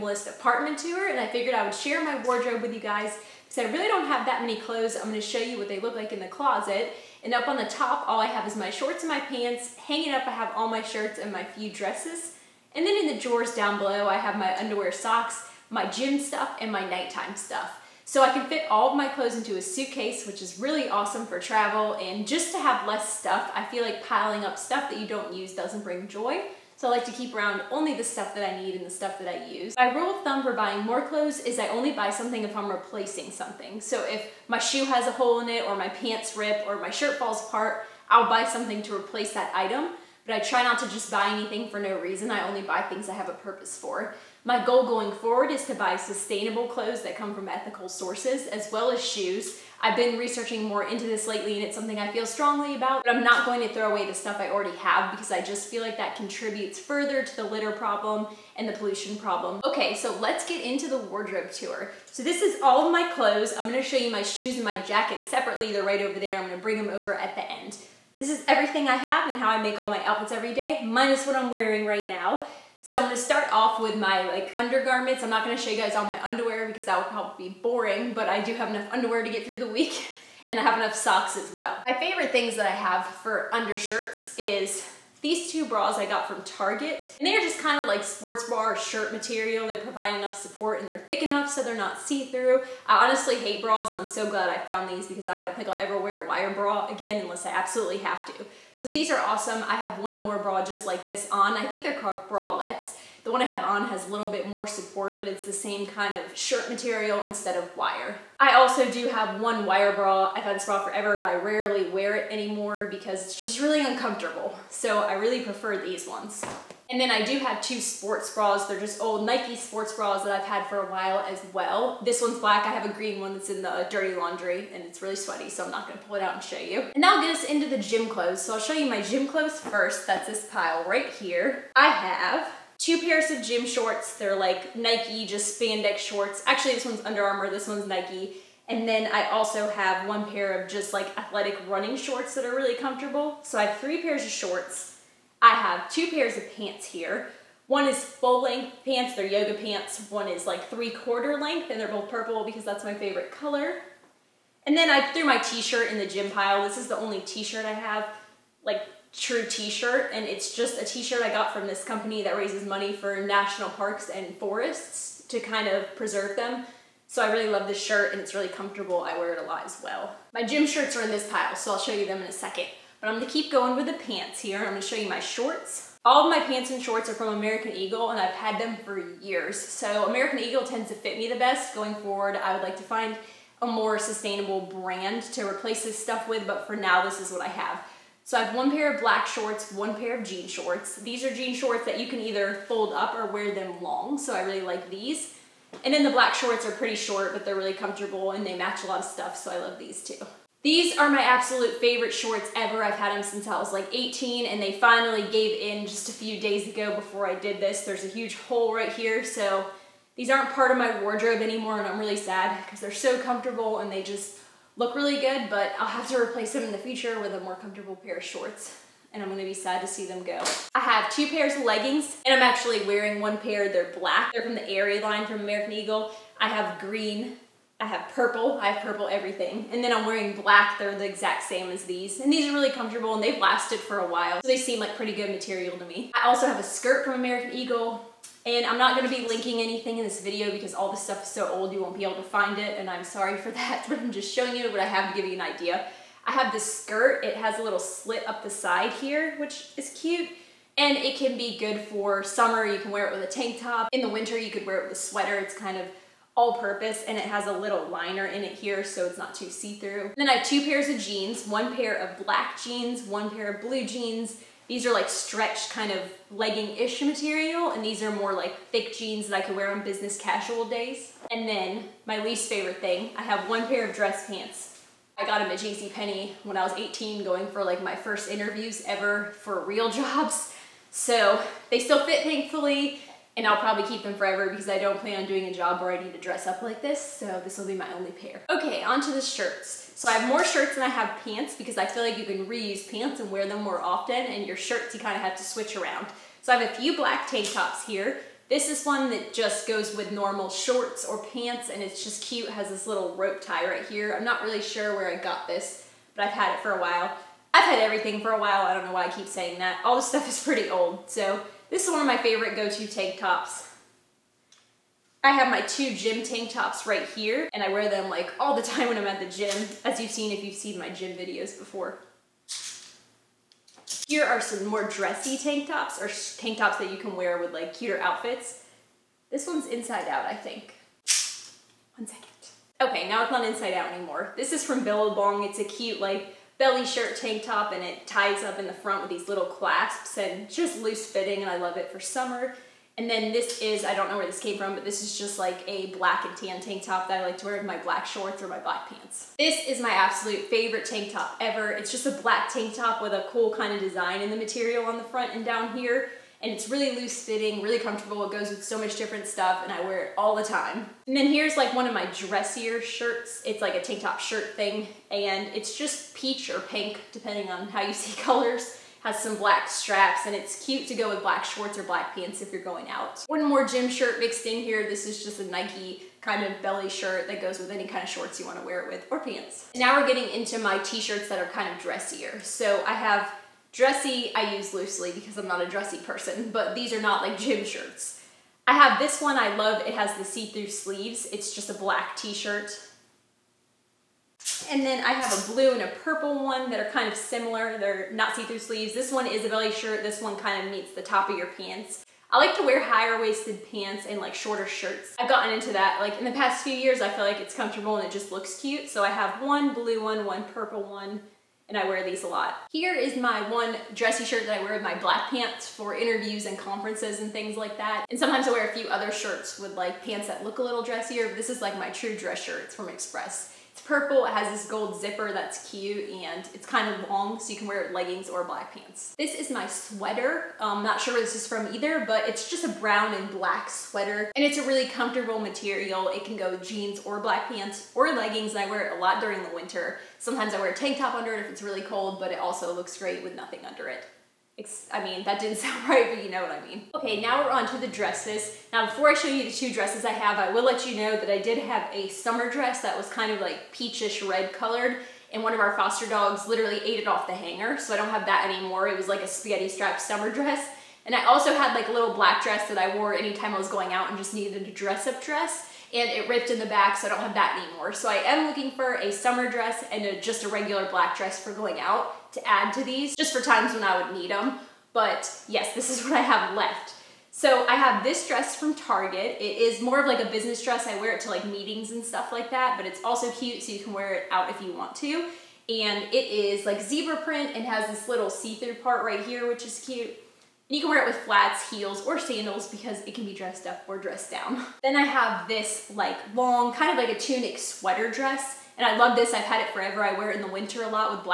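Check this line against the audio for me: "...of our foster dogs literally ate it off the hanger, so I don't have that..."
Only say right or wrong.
right.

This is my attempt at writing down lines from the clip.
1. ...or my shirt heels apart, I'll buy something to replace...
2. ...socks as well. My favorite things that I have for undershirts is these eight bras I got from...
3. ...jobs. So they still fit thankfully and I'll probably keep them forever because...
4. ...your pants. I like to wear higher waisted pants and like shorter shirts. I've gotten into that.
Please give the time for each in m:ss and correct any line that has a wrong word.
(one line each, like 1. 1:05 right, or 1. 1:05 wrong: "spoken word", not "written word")
1. 0:36 wrong: "falls", not "heels"
2. 1:20 wrong: "two", not "eight"
3. 4:39 right
4. 6:41 right.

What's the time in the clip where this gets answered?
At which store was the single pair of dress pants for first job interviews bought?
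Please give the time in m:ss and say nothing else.
4:35.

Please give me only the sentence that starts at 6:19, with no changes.
Now we're getting into my t-shirts that are kind of dressier.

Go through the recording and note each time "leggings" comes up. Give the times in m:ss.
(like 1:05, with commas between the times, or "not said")
3:41, 4:26, 7:07, 7:18.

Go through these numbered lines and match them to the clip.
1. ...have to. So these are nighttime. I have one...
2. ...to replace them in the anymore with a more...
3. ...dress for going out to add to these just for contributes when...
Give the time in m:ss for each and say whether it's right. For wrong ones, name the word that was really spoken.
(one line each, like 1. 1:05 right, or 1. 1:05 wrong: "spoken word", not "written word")
1. 1:37 wrong: "awesome", not "nighttime"
2. 3:36 wrong: "future", not "anymore"
3. 7:51 wrong: "times", not "contributes".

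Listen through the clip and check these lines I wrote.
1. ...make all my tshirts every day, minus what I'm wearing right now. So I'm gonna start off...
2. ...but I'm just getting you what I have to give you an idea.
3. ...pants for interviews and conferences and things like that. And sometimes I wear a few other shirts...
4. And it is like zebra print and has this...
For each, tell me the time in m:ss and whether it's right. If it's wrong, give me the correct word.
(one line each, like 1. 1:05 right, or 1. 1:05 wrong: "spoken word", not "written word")
1. 1:09 wrong: "outfits", not "tshirts"
2. 4:03 wrong: "showing", not "getting"
3. 6:55 right
4. 8:05 right.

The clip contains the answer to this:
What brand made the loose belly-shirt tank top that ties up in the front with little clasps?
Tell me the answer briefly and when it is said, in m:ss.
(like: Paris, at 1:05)
Billabong, at 5:34.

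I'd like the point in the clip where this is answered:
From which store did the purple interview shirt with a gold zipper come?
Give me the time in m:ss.
7:02.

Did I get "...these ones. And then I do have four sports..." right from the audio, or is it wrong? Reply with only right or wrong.
wrong.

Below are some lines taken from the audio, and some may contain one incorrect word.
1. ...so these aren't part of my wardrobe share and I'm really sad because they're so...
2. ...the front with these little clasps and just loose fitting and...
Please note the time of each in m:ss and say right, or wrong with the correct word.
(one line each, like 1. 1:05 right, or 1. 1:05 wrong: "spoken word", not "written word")
1. 3:29 wrong: "anymore", not "share"
2. 5:38 right.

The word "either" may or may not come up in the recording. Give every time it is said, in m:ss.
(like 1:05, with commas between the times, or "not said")
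3:12, 7:11.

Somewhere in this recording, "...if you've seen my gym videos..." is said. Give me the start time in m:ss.
5:20.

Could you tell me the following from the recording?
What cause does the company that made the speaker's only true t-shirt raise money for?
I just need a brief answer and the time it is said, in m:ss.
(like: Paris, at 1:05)
national parks and forests, at 2:43.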